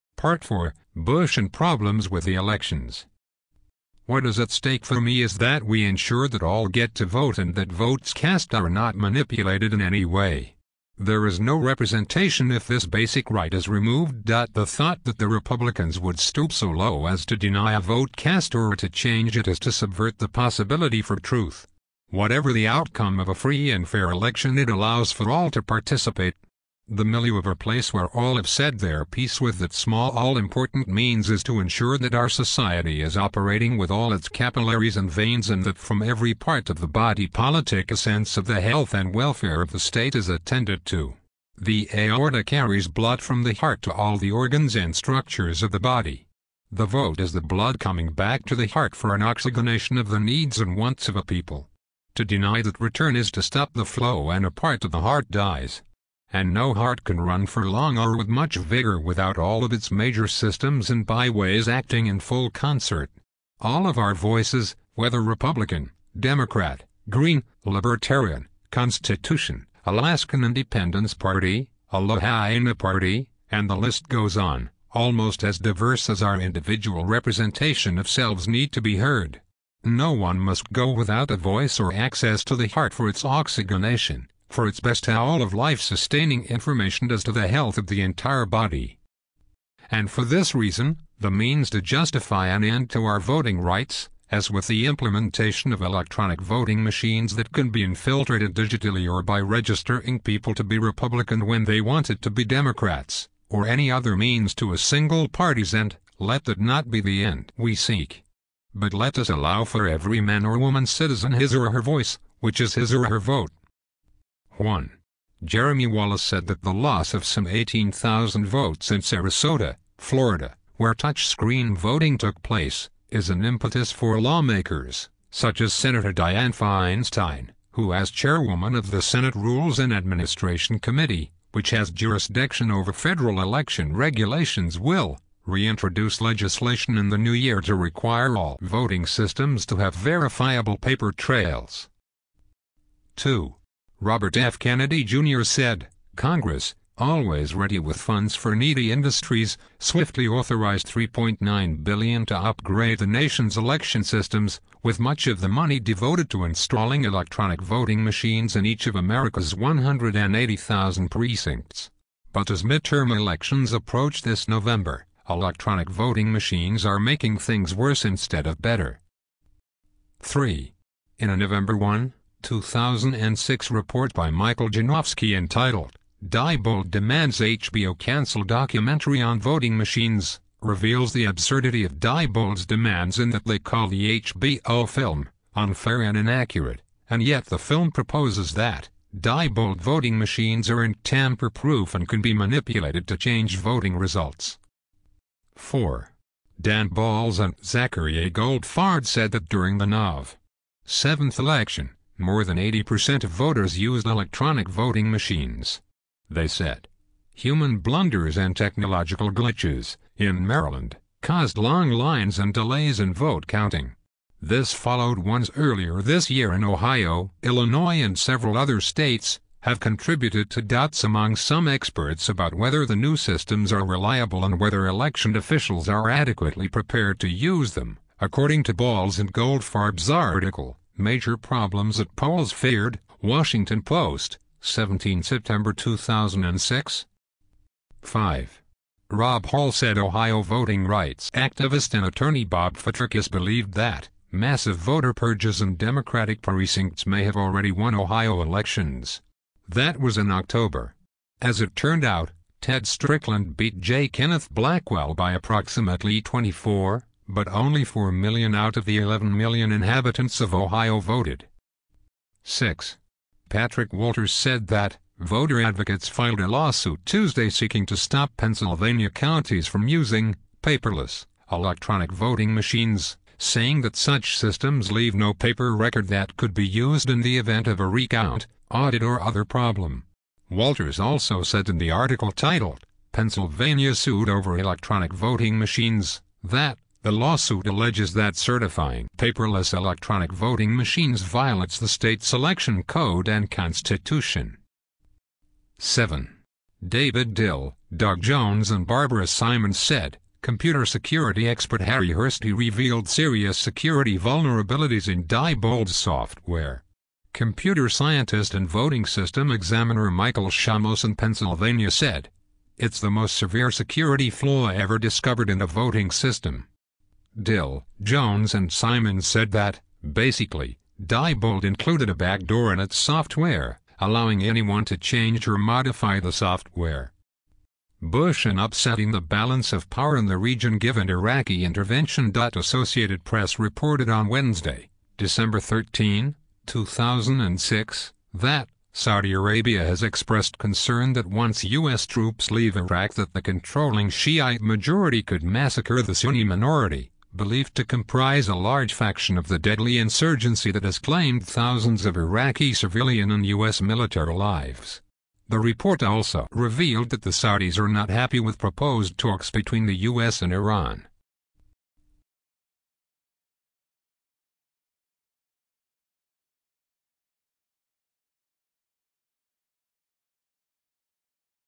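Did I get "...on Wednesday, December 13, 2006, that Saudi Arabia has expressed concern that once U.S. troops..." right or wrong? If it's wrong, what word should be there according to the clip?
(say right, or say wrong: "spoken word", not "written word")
right.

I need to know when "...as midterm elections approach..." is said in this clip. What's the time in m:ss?
2:42.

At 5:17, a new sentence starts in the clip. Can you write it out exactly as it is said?
Dill, Jones and Simon said that, basically, Diebold included a backdoor in its software, allowing anyone to change or modify the software.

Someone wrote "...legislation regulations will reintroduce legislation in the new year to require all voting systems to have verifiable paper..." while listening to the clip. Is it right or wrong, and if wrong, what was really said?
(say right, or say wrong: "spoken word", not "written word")
wrong: "election", not "legislation".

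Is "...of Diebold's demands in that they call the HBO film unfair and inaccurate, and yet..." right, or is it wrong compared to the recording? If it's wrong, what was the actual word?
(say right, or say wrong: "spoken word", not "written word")
right.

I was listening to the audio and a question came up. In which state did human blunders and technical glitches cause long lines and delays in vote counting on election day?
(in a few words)
Maryland.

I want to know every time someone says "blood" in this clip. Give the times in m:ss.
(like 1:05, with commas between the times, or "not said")
0:42, 0:47.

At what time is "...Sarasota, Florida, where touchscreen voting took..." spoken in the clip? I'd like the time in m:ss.
1:59.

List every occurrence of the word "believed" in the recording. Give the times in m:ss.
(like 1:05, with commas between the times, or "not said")
4:03, 5:47.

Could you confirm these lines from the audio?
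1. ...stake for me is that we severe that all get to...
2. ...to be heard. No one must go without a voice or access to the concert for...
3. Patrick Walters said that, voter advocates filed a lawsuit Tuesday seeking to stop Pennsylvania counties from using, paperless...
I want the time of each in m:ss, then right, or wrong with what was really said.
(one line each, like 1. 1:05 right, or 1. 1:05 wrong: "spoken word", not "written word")
1. 0:04 wrong: "ensure", not "severe"
2. 1:18 wrong: "heart", not "concert"
3. 4:23 right.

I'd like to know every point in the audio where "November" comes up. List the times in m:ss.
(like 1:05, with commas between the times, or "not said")
2:44, 2:51.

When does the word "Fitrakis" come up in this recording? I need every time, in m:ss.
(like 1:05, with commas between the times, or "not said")
4:02.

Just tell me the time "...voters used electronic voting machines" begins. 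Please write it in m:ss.
3:23.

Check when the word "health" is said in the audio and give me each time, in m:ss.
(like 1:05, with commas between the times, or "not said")
0:38, 1:27.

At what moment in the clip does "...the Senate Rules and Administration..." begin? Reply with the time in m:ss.
2:08.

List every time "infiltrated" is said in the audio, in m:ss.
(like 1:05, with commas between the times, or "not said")
1:37.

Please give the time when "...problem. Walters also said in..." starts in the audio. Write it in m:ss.
4:39.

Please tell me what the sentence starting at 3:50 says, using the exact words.
Major Problems at Polls Feared, Washington Post, 17 September 2006.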